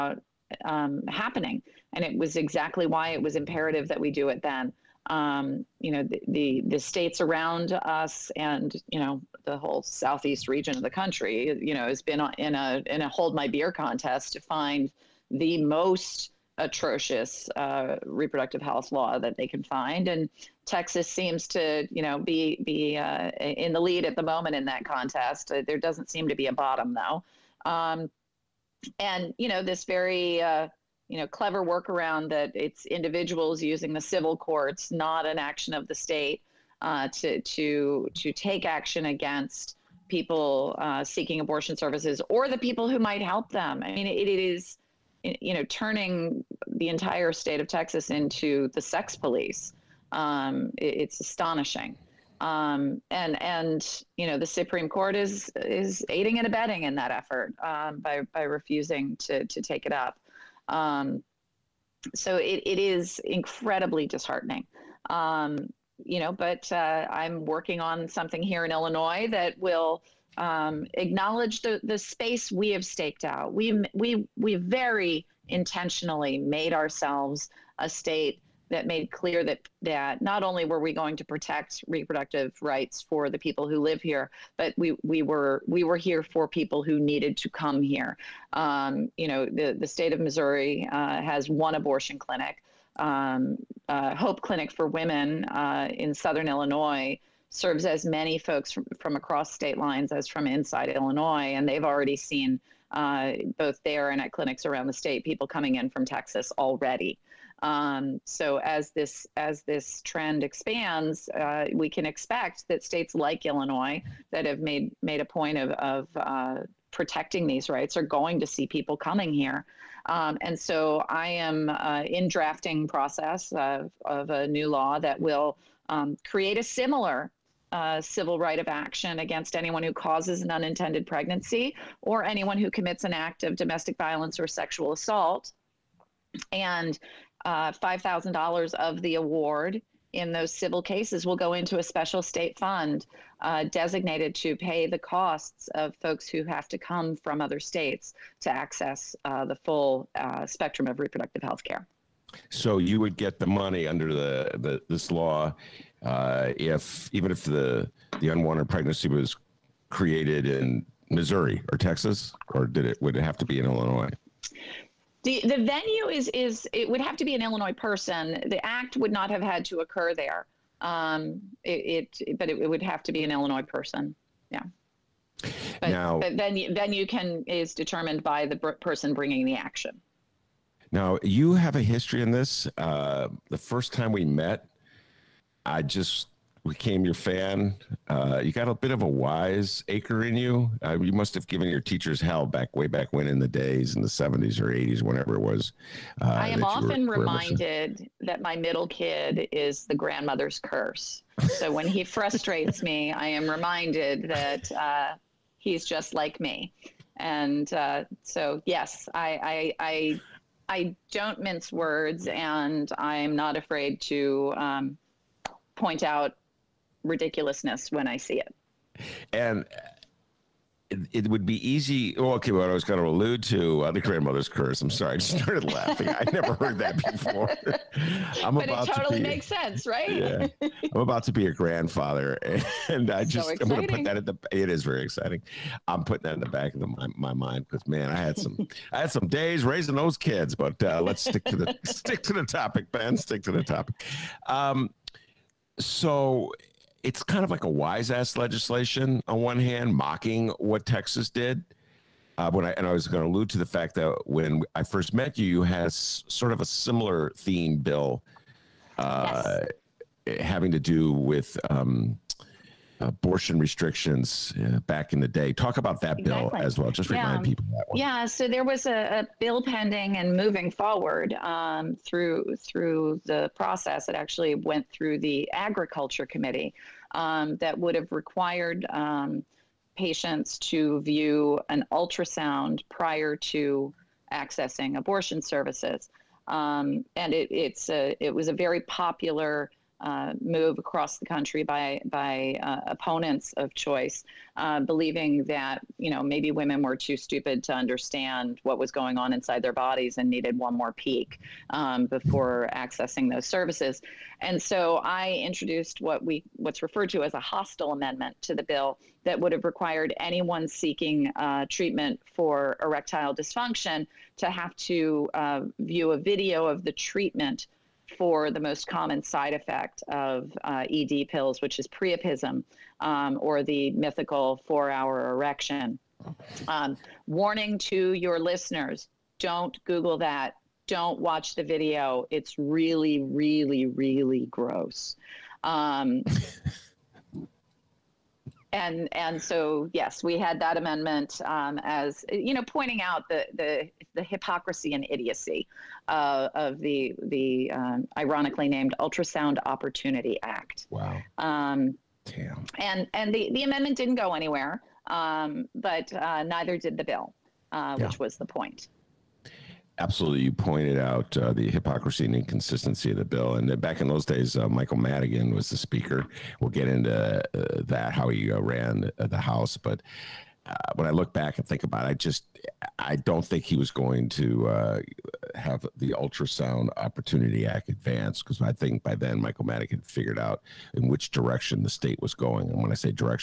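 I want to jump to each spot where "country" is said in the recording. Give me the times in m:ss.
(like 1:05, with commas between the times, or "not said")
0:10, 4:51.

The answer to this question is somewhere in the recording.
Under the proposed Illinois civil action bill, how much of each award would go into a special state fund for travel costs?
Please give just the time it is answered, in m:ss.
2:17.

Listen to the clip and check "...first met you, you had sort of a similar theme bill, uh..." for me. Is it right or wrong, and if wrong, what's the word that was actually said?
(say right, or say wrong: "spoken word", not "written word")
right.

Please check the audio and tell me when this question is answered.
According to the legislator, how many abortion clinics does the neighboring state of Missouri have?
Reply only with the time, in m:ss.
1:31.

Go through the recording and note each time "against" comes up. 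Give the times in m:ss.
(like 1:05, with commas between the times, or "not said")
0:39, 2:09.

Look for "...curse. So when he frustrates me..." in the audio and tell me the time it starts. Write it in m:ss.
3:20.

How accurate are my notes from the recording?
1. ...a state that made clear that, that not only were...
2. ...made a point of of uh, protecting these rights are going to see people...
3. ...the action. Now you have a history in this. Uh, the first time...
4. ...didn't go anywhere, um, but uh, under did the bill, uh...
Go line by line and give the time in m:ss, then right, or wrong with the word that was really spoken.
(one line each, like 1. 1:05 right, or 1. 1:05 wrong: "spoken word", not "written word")
1. 1:17 right
2. 1:55 right
3. 2:59 right
4. 5:53 wrong: "neither", not "under".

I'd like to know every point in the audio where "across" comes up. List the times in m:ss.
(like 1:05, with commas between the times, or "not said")
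1:39, 4:50.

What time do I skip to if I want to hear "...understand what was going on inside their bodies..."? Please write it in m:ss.
4:57.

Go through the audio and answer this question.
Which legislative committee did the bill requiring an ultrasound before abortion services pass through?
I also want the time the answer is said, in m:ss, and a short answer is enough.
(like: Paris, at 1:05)
Agriculture Committee, at 4:35.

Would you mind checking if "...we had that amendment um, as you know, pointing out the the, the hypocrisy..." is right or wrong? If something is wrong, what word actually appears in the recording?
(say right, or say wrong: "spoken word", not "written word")
right.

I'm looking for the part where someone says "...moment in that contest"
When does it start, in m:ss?
0:24.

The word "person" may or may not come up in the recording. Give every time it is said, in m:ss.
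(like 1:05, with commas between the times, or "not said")
2:47, 2:53, 2:58.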